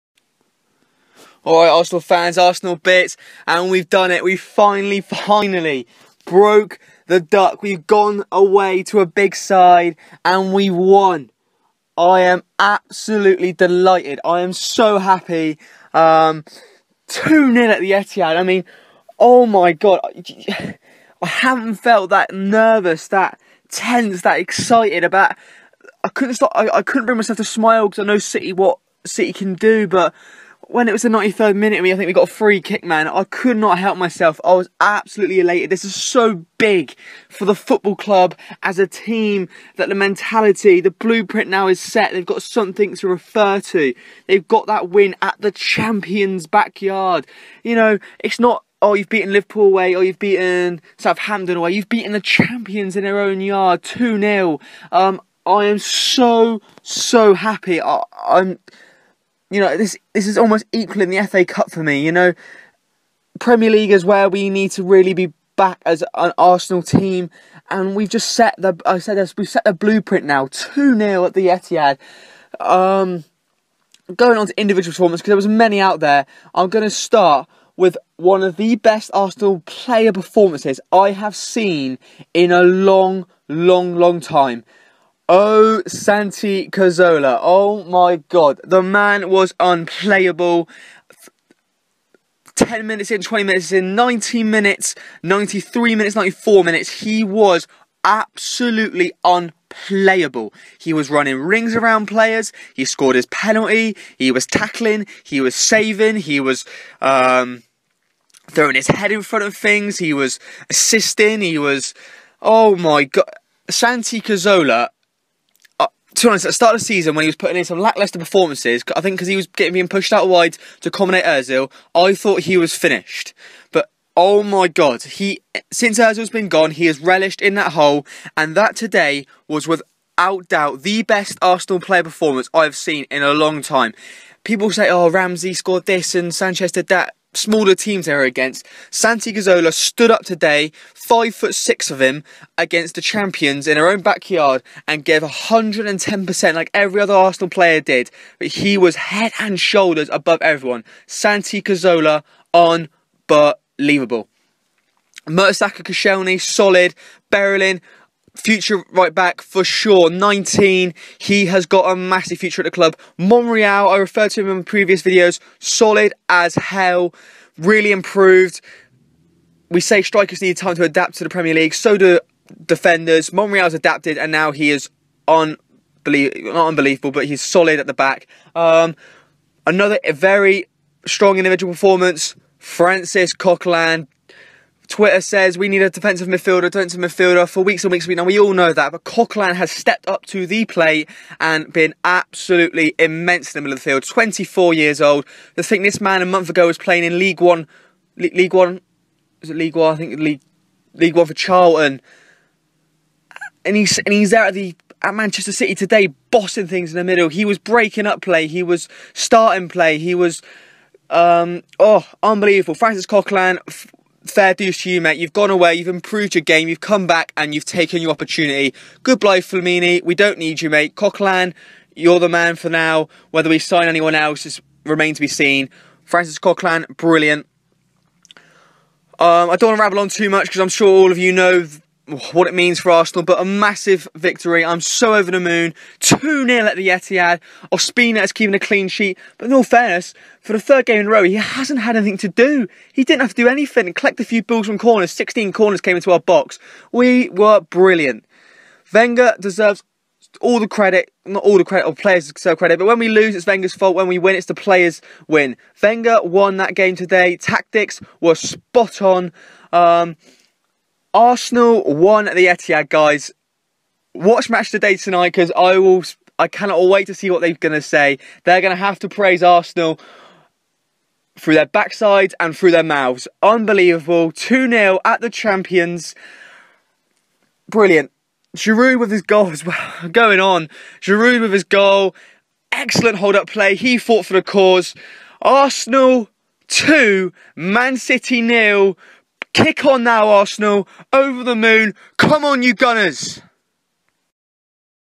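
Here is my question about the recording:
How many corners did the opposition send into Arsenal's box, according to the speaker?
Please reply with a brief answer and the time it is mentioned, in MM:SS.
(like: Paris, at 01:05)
16, at 04:05.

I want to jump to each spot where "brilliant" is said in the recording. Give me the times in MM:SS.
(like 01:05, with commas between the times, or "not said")
03:46, 04:07, 04:37.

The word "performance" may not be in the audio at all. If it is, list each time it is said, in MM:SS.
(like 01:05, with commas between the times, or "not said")
01:14, 01:20, 01:58, 02:12, 03:01.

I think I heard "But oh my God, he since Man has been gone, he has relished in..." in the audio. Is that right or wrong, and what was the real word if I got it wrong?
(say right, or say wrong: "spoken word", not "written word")
wrong: "Özil", not "Man".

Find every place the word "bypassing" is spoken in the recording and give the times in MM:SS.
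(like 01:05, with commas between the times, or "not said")
not said.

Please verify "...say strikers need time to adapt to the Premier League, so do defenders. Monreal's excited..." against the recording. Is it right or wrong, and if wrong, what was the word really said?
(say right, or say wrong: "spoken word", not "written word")
wrong: "adapted", not "excited".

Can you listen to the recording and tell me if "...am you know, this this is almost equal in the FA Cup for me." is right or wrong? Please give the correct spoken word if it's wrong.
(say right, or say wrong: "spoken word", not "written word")
right.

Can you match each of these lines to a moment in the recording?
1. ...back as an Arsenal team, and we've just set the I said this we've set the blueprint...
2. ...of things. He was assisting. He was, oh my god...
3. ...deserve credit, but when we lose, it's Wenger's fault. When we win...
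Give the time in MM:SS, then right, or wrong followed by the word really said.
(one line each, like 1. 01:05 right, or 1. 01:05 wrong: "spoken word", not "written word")
1. 01:05 right
2. 01:49 right
3. 04:12 right.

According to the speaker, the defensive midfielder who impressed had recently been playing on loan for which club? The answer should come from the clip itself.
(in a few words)
Charlton.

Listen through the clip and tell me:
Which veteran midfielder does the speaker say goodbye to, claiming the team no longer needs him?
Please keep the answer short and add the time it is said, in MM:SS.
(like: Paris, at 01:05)
Flamini, at 03:39.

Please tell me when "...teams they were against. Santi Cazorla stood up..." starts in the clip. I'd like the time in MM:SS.
02:17.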